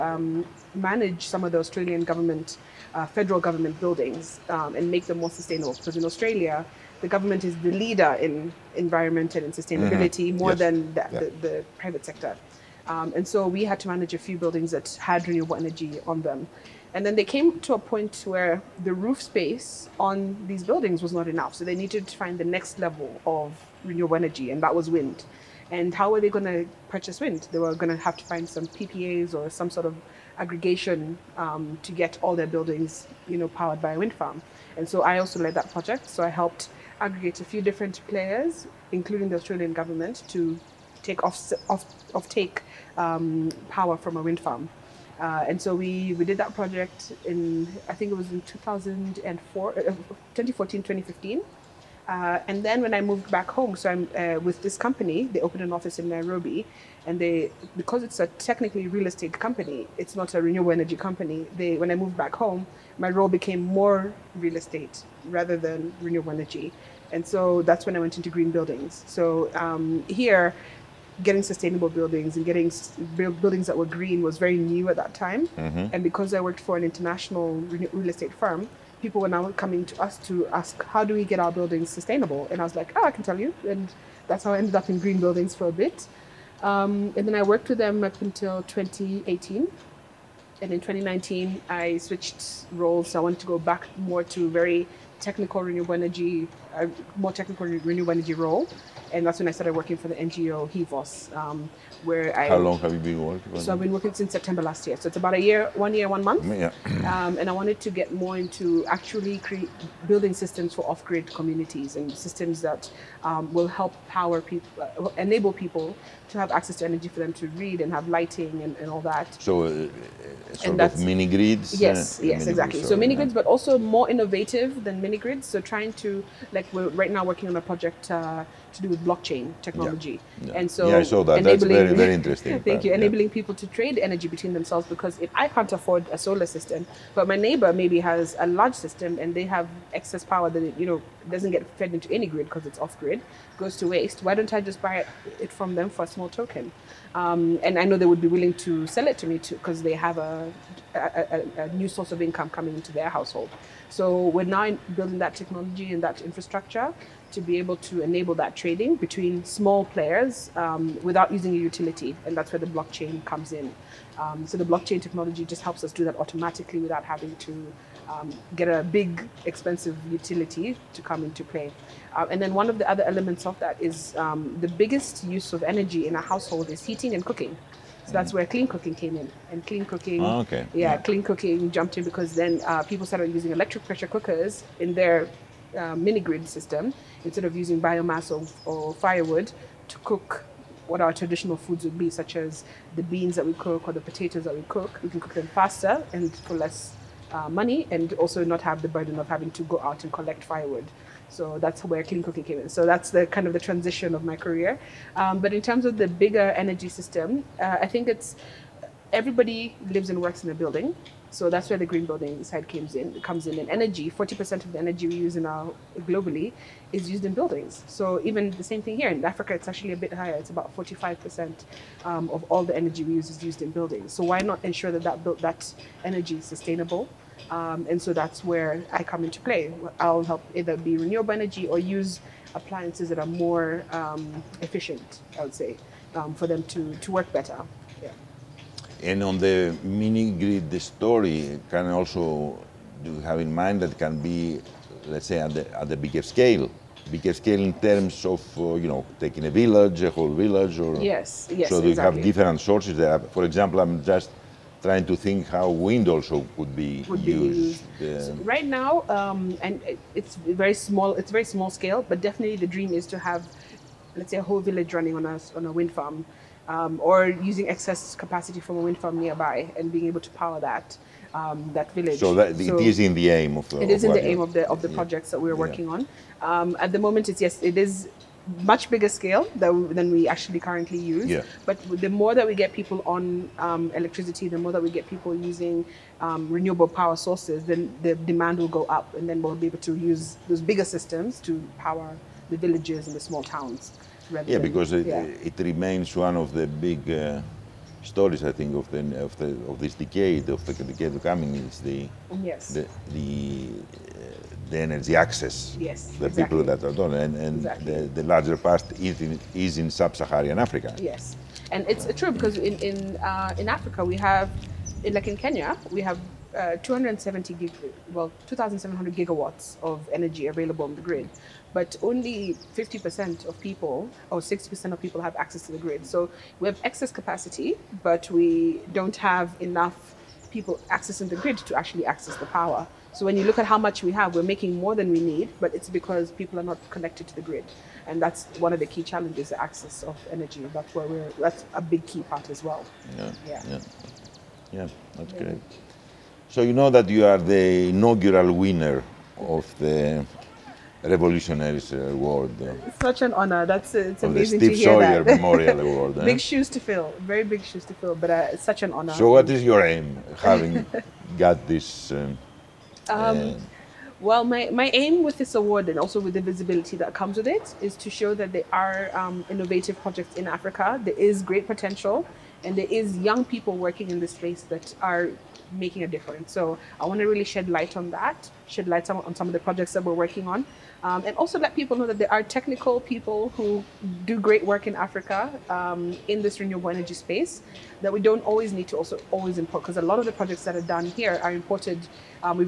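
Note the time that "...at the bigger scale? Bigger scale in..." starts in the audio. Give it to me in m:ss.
4:05.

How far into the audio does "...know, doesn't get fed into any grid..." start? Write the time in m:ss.
2:20.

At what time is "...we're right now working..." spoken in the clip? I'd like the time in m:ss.
2:06.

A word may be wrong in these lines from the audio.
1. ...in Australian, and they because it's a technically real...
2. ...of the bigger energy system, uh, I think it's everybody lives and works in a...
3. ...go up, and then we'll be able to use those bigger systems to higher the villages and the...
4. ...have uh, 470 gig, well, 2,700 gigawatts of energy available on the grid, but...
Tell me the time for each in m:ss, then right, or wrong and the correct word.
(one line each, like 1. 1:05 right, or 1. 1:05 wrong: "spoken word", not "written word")
1. 0:56 wrong: "Nairobi", not "Australian"
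2. 3:25 right
3. 4:48 wrong: "power", not "higher"
4. 5:16 wrong: "270", not "470".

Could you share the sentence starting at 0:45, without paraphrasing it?
Uh, and so we, we did that project in, I think it was in 2004, uh, 2014, 2015.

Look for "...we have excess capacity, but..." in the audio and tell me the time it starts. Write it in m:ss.
5:26.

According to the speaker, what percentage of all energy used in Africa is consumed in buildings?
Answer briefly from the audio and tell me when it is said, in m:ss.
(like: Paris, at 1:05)
45%, at 3:40.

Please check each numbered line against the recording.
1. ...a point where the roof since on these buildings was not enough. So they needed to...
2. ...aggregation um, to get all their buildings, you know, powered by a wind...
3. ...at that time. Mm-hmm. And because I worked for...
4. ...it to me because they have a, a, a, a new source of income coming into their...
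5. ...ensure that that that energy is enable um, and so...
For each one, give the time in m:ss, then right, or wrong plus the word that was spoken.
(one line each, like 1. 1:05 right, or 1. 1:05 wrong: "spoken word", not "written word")
1. 0:17 wrong: "space", not "since"
2. 0:30 right
3. 1:14 right
4. 2:29 right
5. 3:44 wrong: "sustainable", not "enable".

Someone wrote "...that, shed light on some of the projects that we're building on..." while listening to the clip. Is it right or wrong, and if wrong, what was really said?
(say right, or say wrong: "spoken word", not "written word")
wrong: "working", not "building".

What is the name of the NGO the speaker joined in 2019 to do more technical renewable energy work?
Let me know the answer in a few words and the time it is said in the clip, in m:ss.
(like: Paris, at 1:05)
HEVOS, at 1:40.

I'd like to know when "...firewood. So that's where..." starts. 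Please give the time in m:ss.
3:20.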